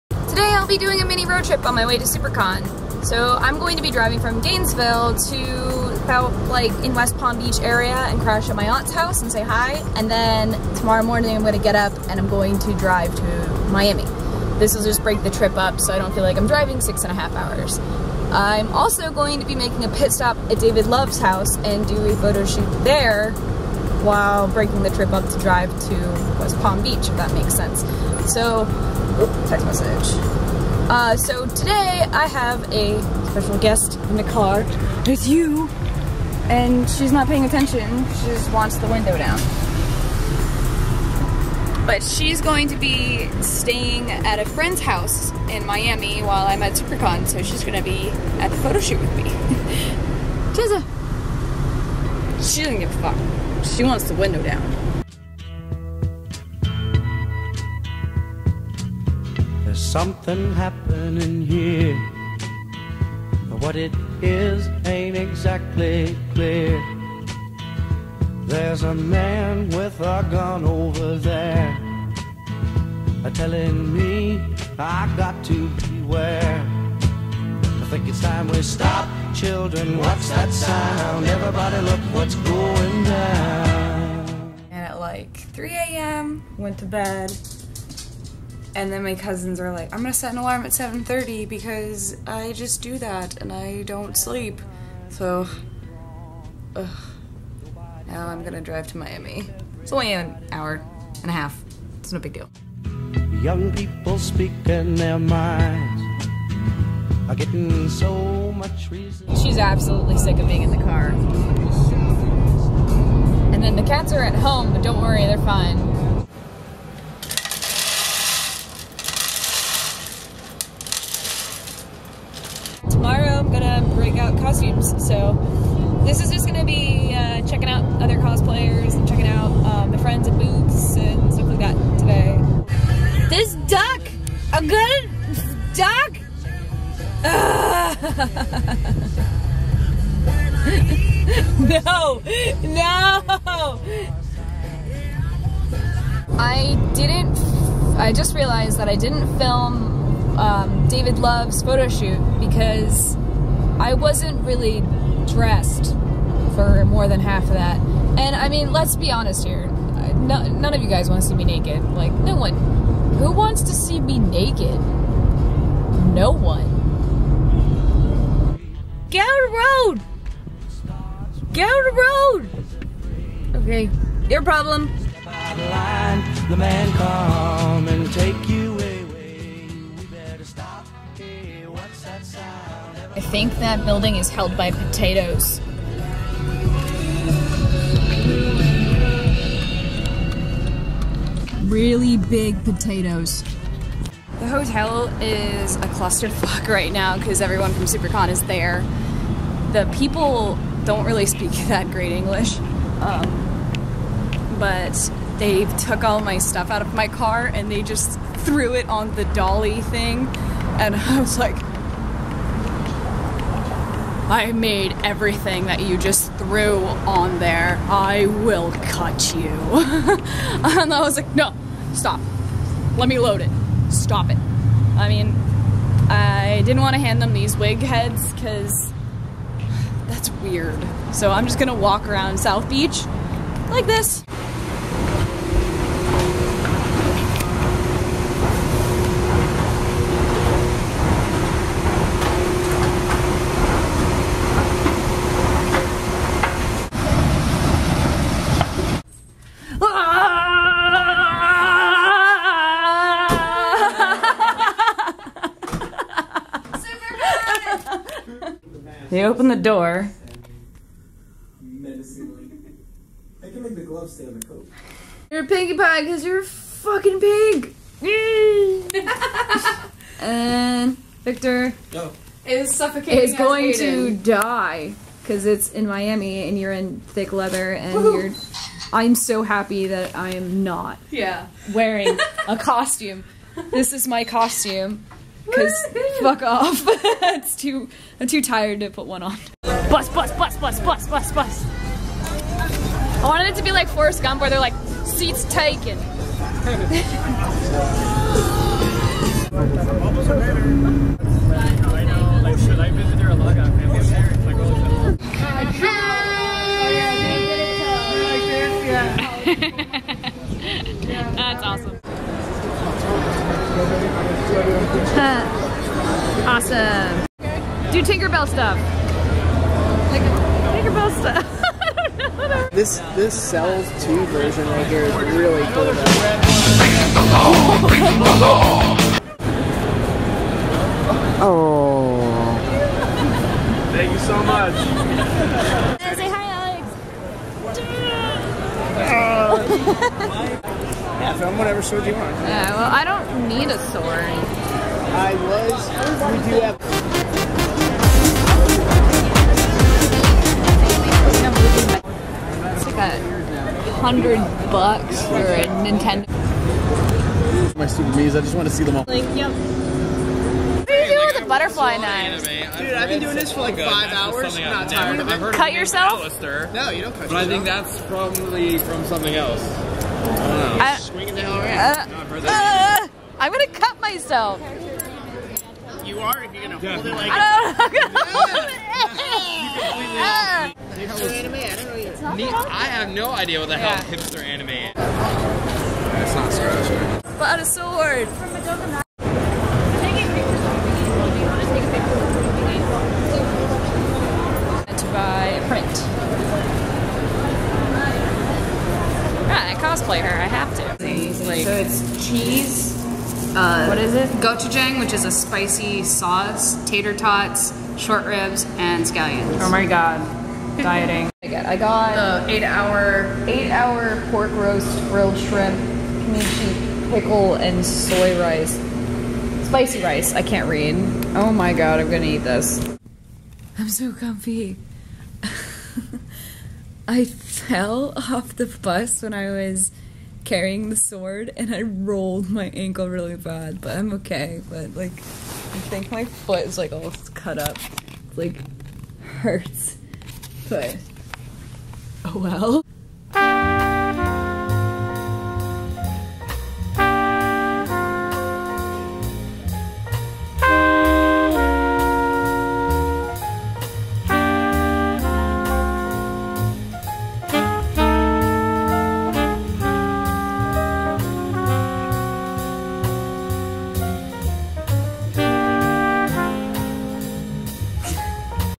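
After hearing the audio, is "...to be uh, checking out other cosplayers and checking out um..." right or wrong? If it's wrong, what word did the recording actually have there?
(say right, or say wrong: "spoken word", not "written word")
right.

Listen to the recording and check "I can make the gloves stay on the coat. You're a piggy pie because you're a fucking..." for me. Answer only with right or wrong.
right.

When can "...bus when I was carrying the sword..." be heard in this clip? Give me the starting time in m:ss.
7:08.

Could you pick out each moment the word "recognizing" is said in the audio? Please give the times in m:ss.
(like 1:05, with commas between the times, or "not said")
not said.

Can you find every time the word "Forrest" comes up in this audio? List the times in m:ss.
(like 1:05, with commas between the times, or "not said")
4:53.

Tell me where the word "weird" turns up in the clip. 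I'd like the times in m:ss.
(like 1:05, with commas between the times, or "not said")
3:50.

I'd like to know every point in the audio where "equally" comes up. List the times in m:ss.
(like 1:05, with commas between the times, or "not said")
not said.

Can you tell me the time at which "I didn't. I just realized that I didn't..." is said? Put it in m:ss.
2:26.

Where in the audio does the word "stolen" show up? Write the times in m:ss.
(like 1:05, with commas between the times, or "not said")
not said.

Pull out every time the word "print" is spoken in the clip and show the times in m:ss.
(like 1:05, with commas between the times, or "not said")
6:35.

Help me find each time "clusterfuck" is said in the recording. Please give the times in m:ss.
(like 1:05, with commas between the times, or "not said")
3:15.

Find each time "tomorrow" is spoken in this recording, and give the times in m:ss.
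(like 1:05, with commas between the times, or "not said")
0:10.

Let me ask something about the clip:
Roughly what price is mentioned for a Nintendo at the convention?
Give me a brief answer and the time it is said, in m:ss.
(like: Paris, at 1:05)
a hundred bucks, at 5:52.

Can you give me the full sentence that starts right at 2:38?
And I mean, let's be honest here.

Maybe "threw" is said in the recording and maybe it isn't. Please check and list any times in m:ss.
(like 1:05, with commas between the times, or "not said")
3:28, 3:36.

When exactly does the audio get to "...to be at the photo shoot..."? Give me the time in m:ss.
0:47.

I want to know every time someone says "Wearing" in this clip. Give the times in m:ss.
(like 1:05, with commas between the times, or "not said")
4:41.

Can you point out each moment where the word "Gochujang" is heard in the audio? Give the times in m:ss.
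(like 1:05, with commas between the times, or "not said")
6:44.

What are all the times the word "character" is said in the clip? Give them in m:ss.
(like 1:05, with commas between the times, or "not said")
not said.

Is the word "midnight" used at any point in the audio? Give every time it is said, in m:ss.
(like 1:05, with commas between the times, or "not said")
not said.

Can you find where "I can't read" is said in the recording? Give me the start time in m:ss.
7:00.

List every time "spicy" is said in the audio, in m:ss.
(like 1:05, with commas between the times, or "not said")
6:45, 6:59.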